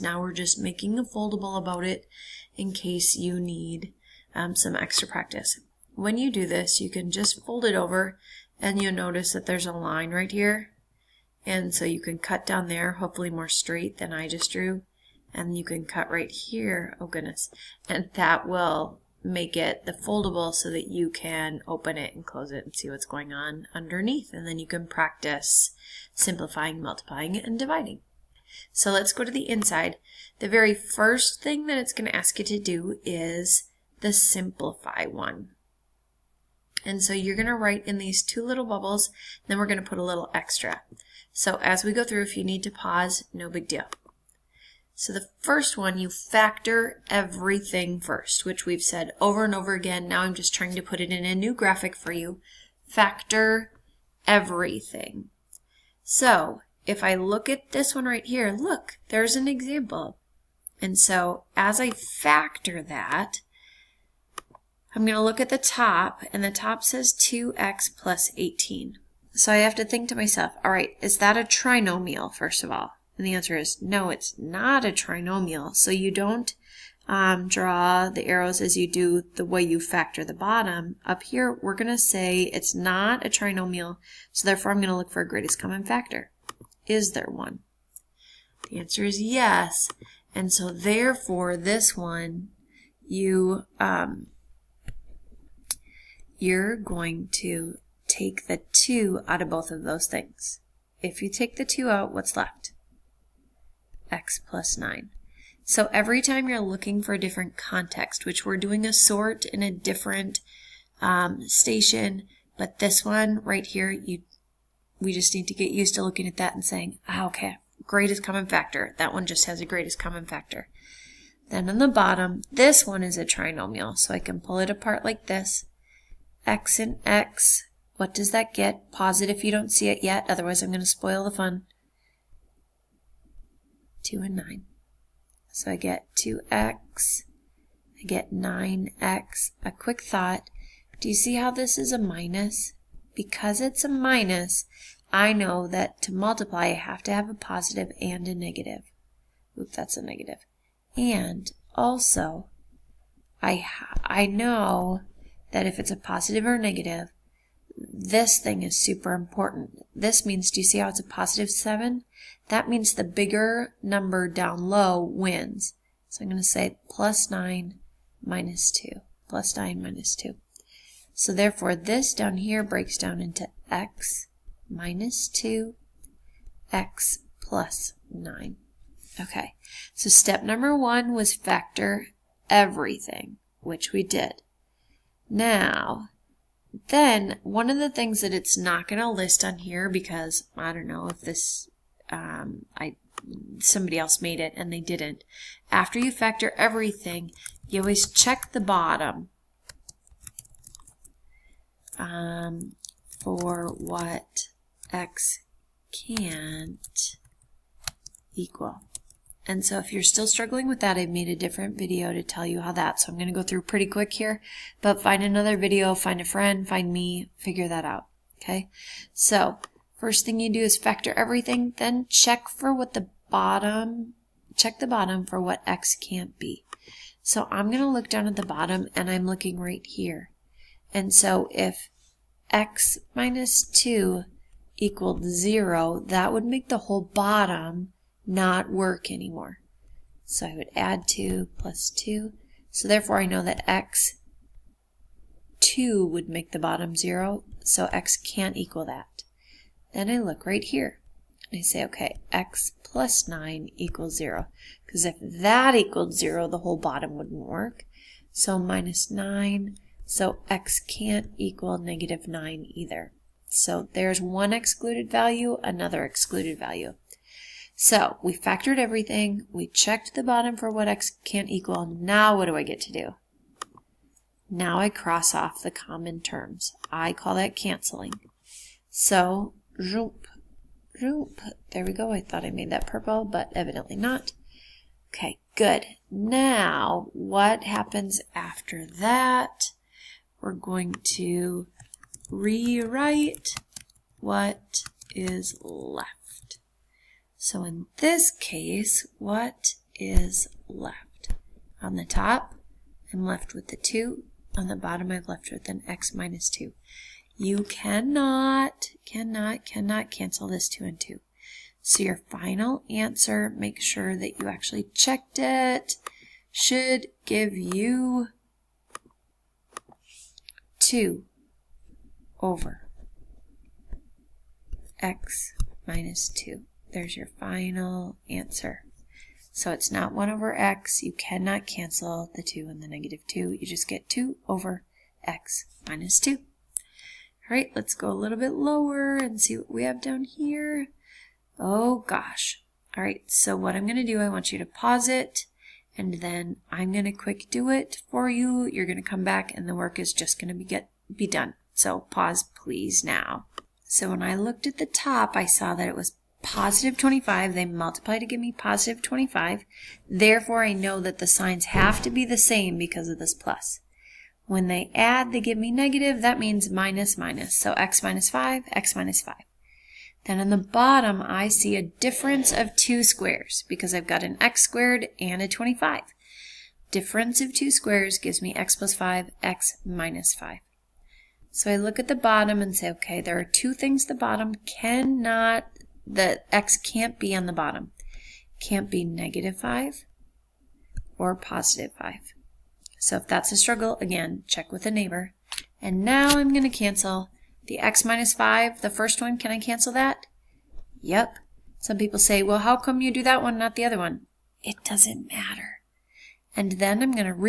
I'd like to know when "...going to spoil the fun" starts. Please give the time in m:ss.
2:10.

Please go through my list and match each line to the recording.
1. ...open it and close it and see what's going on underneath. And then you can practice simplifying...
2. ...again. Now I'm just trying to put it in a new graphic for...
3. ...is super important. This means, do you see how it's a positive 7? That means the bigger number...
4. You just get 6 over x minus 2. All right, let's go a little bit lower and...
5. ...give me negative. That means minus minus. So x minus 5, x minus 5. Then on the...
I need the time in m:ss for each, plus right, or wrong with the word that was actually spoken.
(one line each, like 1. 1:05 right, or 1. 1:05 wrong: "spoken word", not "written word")
1. 0:21 right
2. 0:49 right
3. 2:38 right
4. 5:33 wrong: "2", not "6"
5. 6:05 right.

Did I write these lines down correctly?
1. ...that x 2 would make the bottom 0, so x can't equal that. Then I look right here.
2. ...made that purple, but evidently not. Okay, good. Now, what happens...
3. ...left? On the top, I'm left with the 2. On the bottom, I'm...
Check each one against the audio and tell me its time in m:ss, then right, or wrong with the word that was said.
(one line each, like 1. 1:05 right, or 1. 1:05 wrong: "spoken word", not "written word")
1. 4:03 right
2. 4:42 right
3. 5:00 right.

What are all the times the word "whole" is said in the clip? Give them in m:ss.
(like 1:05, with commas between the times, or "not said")
3:56, 4:16.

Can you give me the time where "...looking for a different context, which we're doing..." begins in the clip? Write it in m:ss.
1:46.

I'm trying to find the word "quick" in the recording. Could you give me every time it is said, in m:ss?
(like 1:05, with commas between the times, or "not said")
2:19, 3:33, 5:47.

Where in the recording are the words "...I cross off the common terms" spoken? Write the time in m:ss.
4:34.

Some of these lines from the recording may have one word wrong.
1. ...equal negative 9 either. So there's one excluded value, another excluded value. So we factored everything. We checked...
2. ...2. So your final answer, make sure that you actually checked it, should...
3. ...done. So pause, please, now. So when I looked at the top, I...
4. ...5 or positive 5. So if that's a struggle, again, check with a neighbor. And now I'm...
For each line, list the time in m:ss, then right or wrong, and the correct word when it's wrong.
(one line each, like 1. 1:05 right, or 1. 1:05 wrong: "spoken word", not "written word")
1. 4:21 right
2. 5:10 right
3. 5:51 right
4. 6:29 right.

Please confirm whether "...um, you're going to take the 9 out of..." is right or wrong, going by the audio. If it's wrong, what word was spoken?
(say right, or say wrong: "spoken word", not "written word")
wrong: "2", not "9".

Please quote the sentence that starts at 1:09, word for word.
So I have to think to myself, all right, is that a trinomial, first of all?